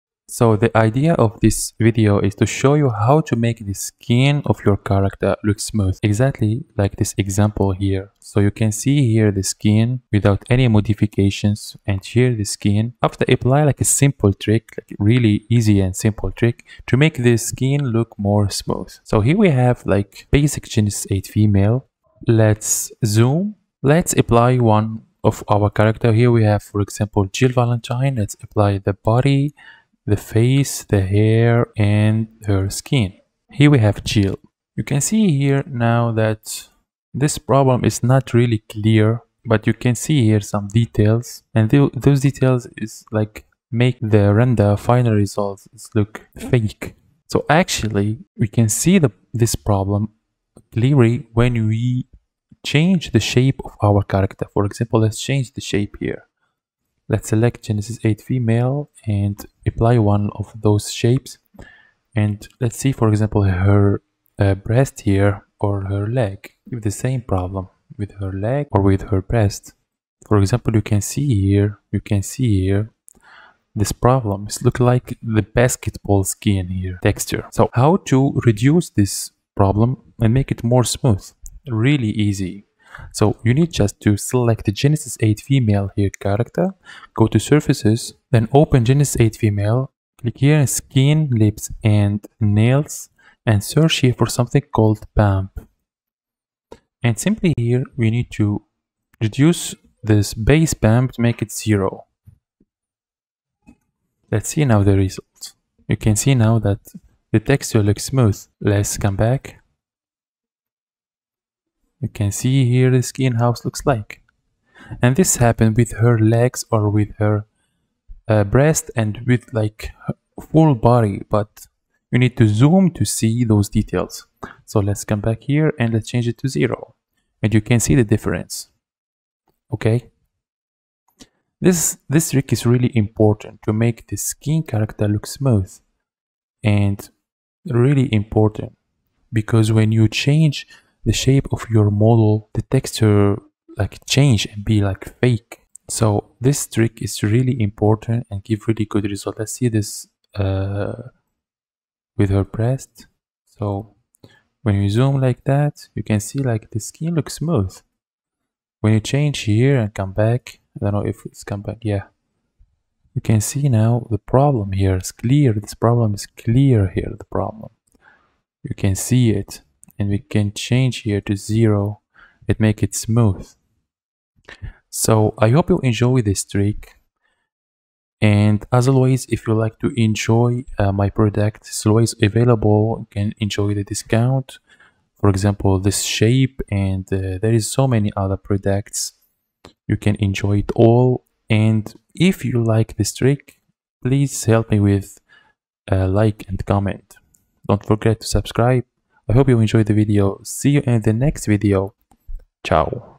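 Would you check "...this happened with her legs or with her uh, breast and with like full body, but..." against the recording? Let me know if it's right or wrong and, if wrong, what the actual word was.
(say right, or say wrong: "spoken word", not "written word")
right.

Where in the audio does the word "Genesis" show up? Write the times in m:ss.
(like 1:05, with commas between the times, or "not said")
0:20, 0:57, 1:24, 1:28.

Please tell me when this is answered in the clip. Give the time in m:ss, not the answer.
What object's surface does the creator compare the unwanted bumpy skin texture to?
1:15.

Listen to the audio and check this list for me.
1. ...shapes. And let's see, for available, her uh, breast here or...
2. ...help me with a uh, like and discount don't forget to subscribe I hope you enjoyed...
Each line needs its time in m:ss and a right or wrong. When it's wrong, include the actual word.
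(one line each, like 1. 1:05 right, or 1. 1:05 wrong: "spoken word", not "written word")
1. 1:00 wrong: "example", not "available"
2. 3:14 wrong: "comment", not "discount".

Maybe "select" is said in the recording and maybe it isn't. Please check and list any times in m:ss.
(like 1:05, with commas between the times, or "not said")
0:57, 1:24.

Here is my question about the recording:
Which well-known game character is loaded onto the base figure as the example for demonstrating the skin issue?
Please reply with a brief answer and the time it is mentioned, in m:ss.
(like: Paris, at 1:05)
Jill Valentine, at 0:27.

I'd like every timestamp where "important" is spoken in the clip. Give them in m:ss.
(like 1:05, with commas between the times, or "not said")
2:12, 2:18, 2:27.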